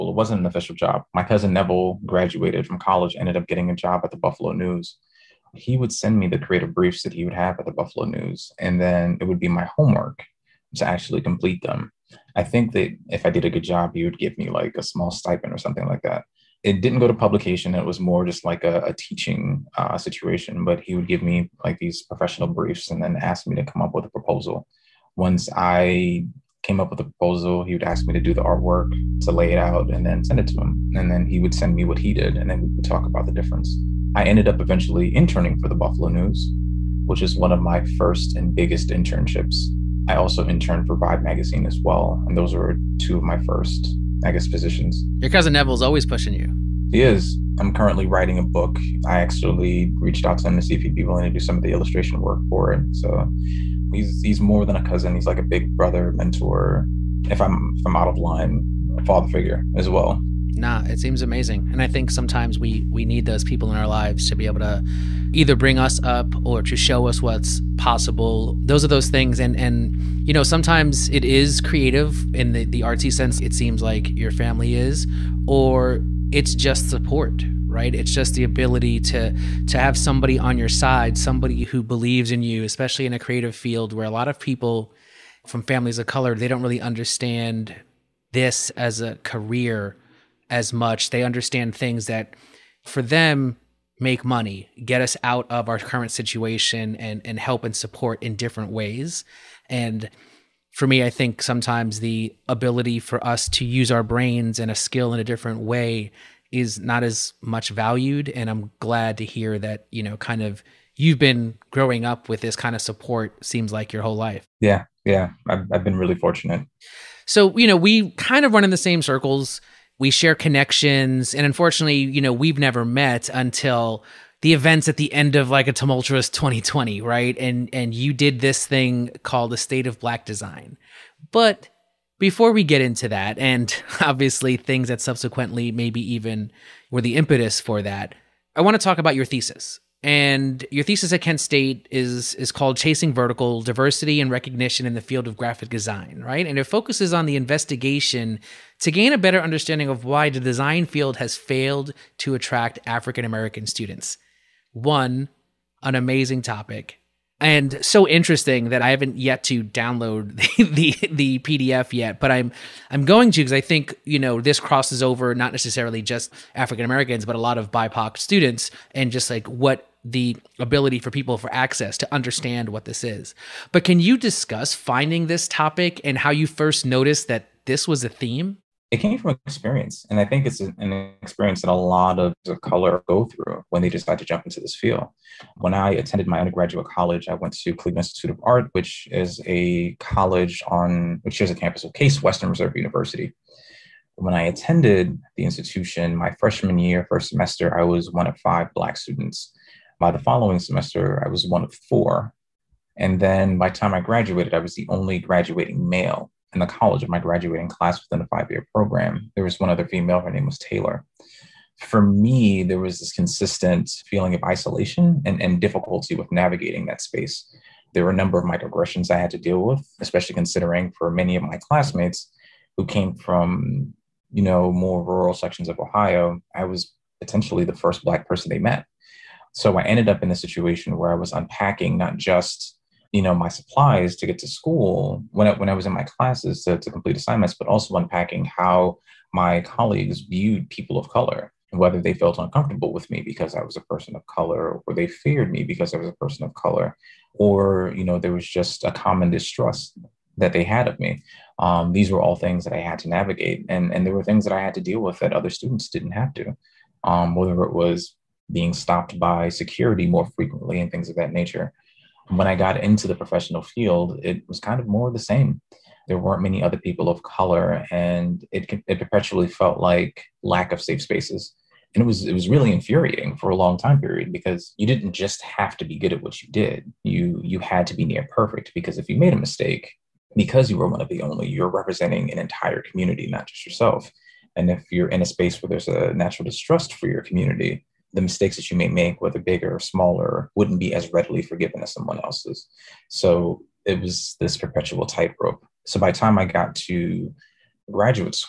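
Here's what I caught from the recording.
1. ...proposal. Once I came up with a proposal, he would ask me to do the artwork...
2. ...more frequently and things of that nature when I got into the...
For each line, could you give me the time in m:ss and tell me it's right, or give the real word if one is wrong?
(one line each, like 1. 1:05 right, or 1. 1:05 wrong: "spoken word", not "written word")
1. 0:24 right
2. 4:20 right.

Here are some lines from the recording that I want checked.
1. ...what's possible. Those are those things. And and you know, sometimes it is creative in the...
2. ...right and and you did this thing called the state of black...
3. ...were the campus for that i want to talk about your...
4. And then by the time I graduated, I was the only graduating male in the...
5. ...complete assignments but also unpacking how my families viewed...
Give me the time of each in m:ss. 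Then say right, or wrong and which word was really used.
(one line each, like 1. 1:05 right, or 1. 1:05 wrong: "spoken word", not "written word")
1. 1:07 right
2. 2:07 right
3. 2:16 wrong: "impetus", not "campus"
4. 3:22 right
5. 3:56 wrong: "colleagues", not "families".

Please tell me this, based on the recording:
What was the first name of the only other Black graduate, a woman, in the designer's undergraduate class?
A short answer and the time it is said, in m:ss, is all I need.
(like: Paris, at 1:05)
Taylor, at 3:30.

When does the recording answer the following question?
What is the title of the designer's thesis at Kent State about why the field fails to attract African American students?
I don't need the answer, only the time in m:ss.
2:22.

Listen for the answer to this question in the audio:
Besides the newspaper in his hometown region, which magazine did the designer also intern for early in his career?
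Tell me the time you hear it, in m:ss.
0:40.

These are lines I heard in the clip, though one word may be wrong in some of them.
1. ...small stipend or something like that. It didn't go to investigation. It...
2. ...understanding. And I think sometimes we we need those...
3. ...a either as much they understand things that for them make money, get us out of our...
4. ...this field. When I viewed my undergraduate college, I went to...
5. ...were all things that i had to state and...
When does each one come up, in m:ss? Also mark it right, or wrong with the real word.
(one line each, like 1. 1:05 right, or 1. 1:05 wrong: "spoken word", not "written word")
1. 0:14 wrong: "publication", not "investigation"
2. 1:01 wrong: "amazing", not "understanding"
3. 1:28 wrong: "career", not "either"
4. 3:04 wrong: "attended", not "viewed"
5. 4:12 wrong: "navigate", not "state".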